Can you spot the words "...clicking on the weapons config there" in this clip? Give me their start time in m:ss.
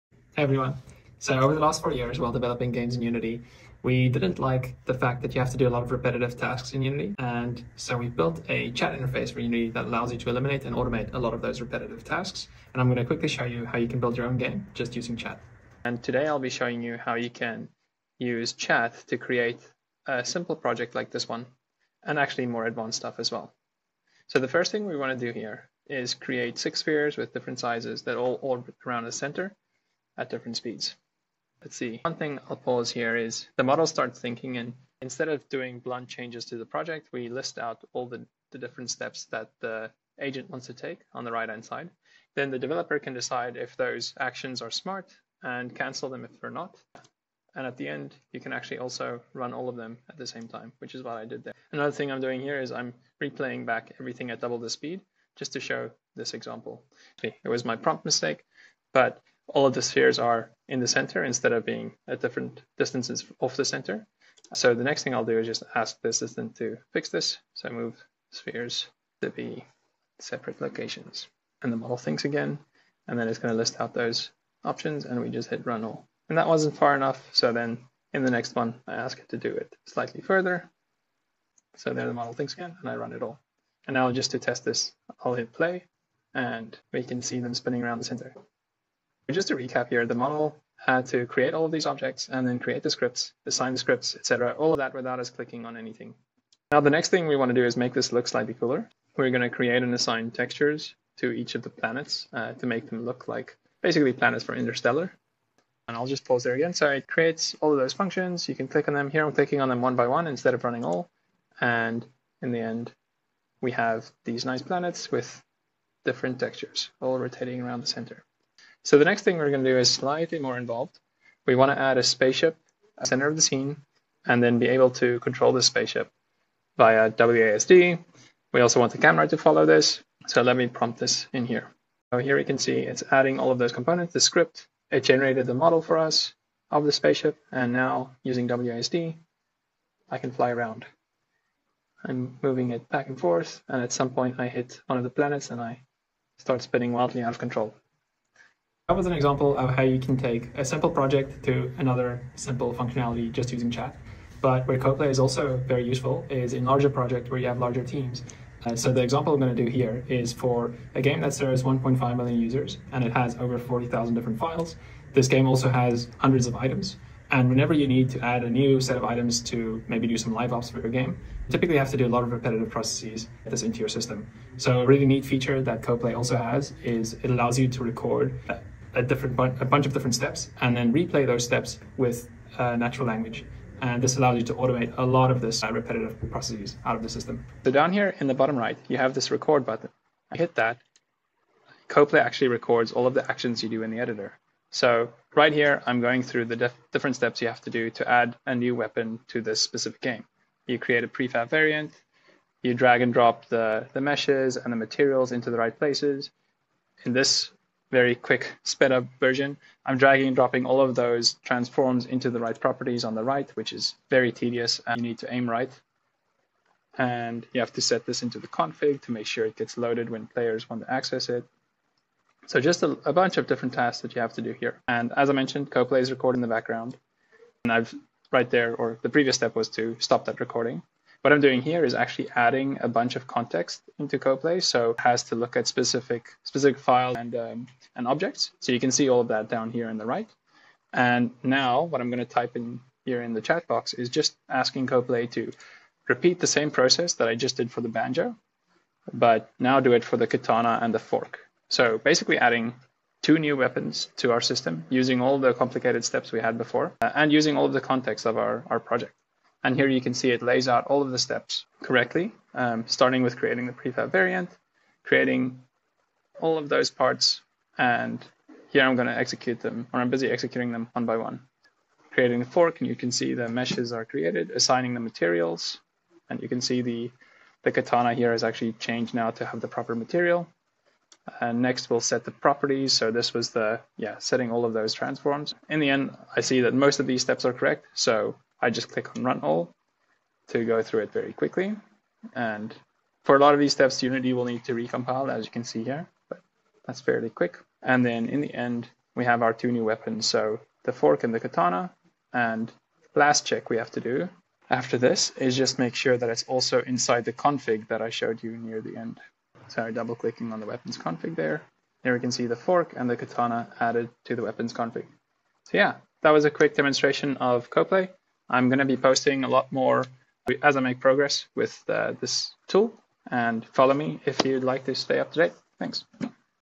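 5:10.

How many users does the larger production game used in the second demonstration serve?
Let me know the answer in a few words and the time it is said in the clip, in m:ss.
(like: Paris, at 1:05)
1.5 million, at 2:41.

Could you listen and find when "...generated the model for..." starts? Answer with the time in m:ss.
2:15.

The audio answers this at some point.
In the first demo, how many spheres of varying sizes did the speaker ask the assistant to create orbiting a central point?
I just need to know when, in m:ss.
0:26.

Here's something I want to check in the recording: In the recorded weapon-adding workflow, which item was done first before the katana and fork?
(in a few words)
banjo.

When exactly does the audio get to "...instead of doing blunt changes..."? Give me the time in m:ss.
0:35.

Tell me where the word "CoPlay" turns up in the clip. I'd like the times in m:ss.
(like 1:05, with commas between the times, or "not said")
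2:34, 2:55, 3:11, 3:45, 3:54, 4:04, 5:17.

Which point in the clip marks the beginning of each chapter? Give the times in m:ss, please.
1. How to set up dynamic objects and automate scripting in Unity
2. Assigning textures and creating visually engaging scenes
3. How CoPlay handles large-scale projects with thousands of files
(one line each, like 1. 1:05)
1. 0:16
2. 1:36
3. 2:28.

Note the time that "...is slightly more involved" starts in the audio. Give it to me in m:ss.
1:59.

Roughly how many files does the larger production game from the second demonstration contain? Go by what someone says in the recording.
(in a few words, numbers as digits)
over 40,000.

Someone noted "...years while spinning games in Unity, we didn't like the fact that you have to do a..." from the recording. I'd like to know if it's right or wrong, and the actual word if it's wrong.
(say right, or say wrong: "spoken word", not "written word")
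wrong: "developing", not "spinning".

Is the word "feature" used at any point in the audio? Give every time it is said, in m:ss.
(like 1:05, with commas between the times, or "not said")
2:55.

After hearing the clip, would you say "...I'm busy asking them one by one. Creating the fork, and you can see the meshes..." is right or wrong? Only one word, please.
wrong.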